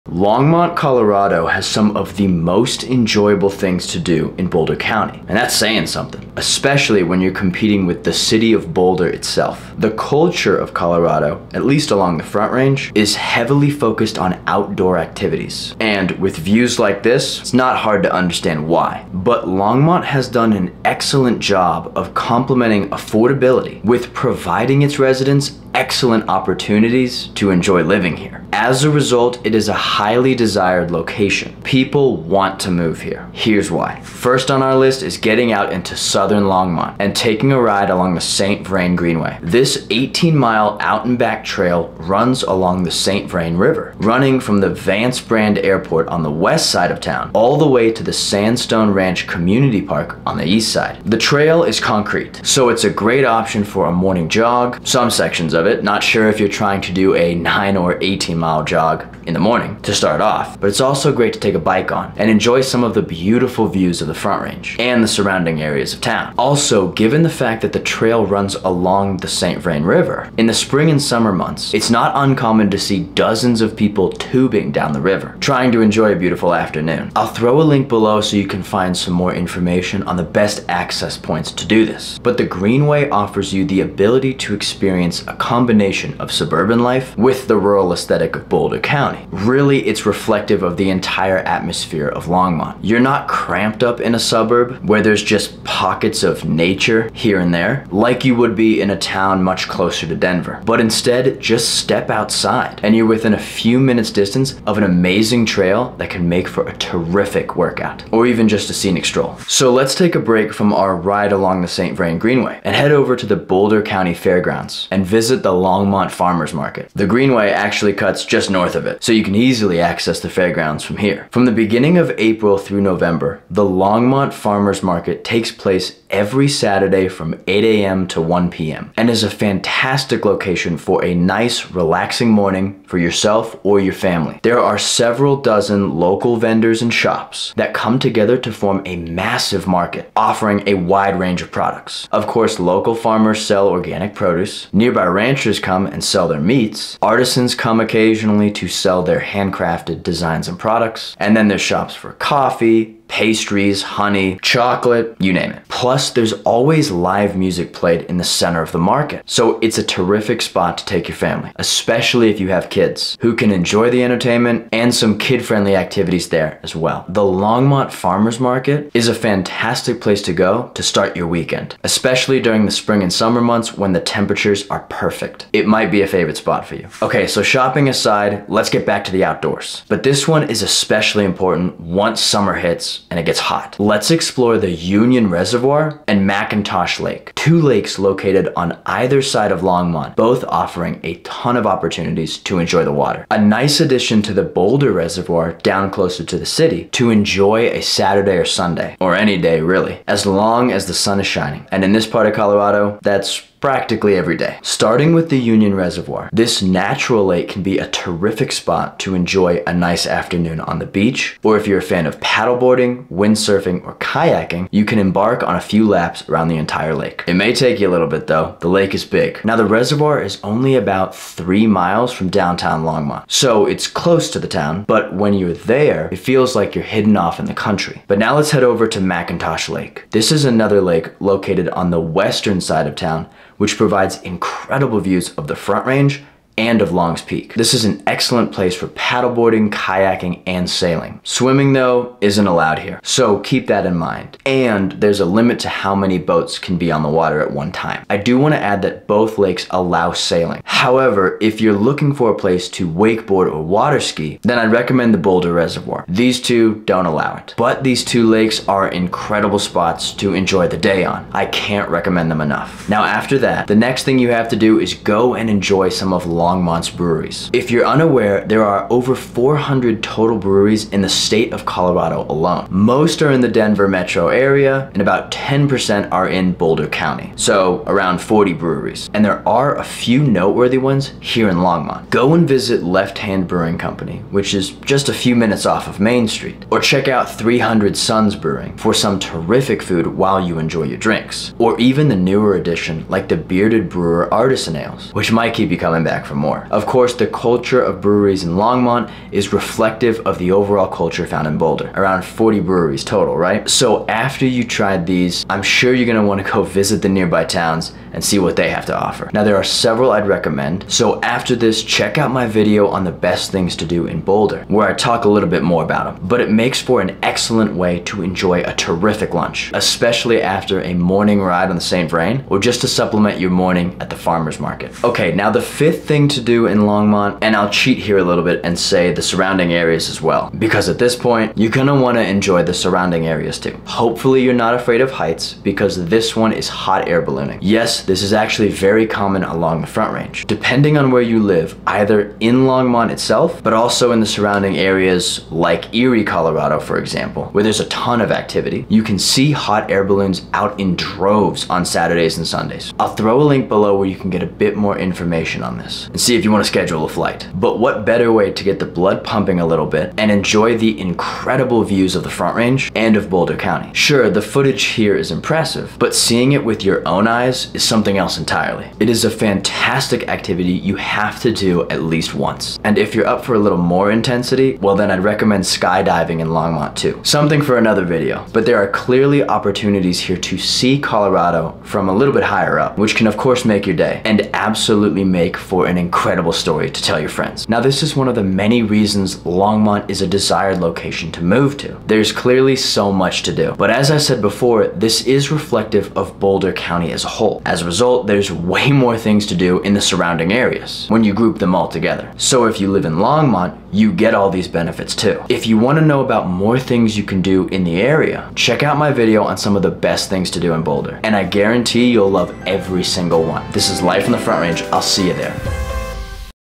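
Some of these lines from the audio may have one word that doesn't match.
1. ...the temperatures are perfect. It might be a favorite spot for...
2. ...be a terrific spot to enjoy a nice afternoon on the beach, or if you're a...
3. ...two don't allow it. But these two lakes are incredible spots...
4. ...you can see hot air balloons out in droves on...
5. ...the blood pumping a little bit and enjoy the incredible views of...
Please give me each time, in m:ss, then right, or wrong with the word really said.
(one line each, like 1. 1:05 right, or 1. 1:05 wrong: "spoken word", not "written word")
1. 2:53 right
2. 3:27 right
3. 4:16 right
4. 5:48 right
5. 5:58 right.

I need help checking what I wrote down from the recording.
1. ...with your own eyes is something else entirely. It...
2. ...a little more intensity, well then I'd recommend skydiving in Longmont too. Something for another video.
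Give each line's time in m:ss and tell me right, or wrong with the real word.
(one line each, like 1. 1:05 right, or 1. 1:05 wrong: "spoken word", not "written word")
1. 6:06 right
2. 6:13 right.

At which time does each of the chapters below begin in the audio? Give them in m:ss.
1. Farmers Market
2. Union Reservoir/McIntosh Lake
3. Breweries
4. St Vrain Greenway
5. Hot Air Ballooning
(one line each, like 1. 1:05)
1. 1:49
2. 2:57
3. 4:22
4. 0:34
5. 5:25.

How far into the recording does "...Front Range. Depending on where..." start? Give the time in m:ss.
5:39.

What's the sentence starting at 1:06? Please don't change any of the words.
Also, given the fact that the trail runs along the St.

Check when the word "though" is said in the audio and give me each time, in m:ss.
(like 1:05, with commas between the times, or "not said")
3:38, 4:01.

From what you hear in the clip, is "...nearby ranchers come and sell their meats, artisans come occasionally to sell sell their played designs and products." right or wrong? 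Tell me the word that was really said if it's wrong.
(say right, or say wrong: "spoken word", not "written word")
wrong: "handcrafted", not "played".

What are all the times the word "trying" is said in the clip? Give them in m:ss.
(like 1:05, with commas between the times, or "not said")
0:56, 1:15.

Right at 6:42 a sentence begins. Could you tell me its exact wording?
So if you live in Longmont, you get all these benefits too.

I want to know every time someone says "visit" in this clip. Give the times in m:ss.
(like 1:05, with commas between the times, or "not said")
1:55, 4:42, 5:06.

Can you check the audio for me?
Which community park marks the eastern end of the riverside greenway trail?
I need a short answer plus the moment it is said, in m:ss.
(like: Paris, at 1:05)
Sandstone Ranch Community Park, at 0:48.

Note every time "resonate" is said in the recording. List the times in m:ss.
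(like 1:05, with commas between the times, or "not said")
not said.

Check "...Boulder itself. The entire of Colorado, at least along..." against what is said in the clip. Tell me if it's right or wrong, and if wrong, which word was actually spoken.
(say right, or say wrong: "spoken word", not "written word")
wrong: "culture", not "entire".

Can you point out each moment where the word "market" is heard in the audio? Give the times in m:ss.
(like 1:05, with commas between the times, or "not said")
1:56, 2:04, 2:19, 2:38, 2:48, 5:24.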